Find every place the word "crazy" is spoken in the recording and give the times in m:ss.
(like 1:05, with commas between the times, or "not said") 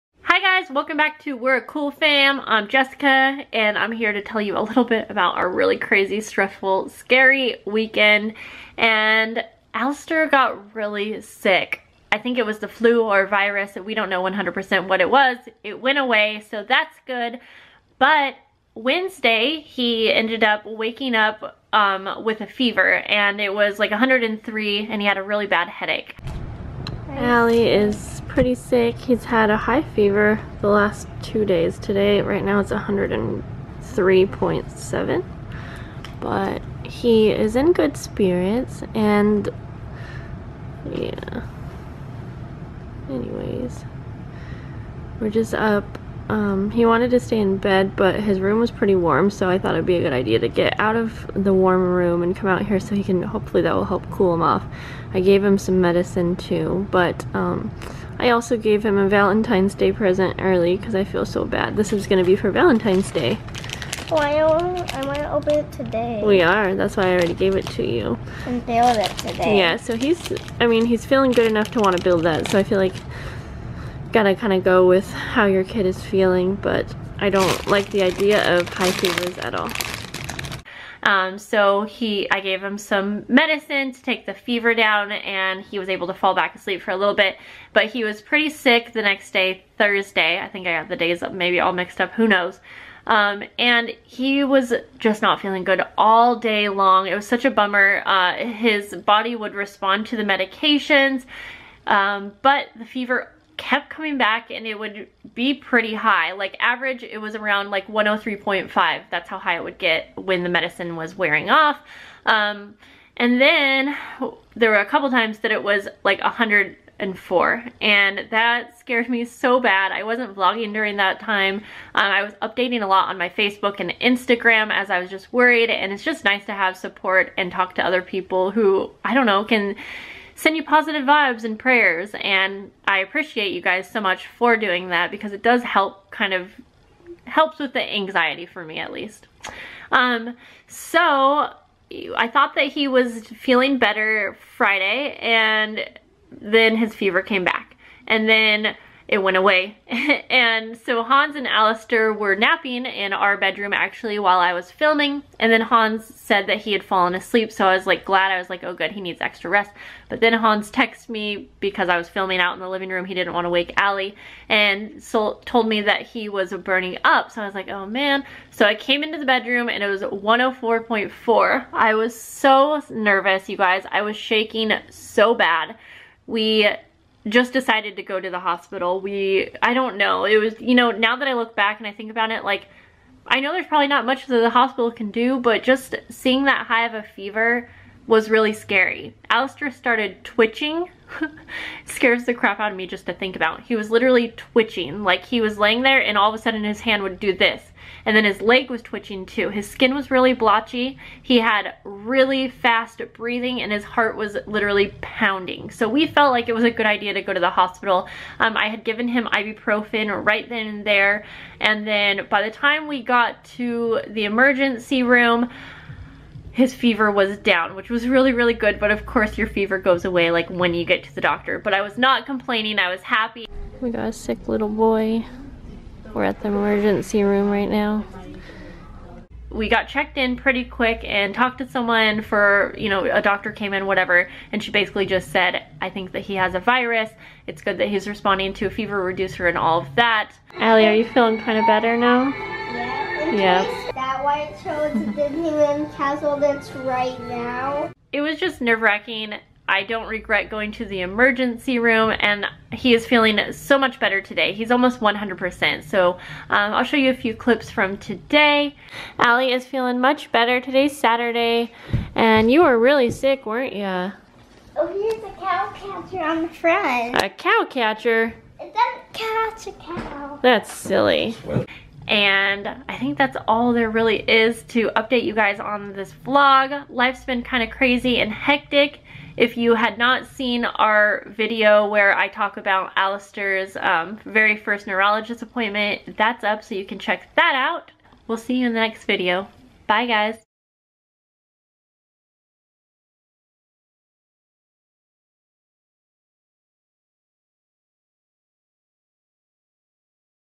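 0:05, 4:37.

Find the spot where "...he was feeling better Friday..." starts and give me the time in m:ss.
2:22.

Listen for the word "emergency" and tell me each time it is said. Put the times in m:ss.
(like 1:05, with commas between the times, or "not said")
3:34, 3:46, 4:11.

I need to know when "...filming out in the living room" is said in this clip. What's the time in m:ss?
2:42.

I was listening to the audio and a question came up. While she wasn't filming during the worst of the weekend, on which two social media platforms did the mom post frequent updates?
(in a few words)
Facebook and Instagram.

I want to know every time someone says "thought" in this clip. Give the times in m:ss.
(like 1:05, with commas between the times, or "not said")
0:49, 2:22.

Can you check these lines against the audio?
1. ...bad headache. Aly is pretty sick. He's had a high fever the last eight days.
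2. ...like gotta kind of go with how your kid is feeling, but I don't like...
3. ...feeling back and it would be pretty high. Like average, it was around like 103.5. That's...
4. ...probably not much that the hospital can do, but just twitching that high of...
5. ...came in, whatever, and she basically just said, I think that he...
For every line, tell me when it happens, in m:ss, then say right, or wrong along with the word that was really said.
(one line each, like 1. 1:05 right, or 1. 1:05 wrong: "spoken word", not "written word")
1. 0:25 wrong: "two", not "eight"
2. 1:12 right
3. 1:43 wrong: "coming", not "feeling"
4. 3:03 wrong: "seeing", not "twitching"
5. 3:53 right.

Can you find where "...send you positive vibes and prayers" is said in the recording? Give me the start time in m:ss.
2:10.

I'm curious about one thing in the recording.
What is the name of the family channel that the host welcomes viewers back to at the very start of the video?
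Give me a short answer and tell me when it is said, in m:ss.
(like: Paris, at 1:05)
We're a Cool Fam, at 0:01.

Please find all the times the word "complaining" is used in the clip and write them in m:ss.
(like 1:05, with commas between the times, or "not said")
3:42.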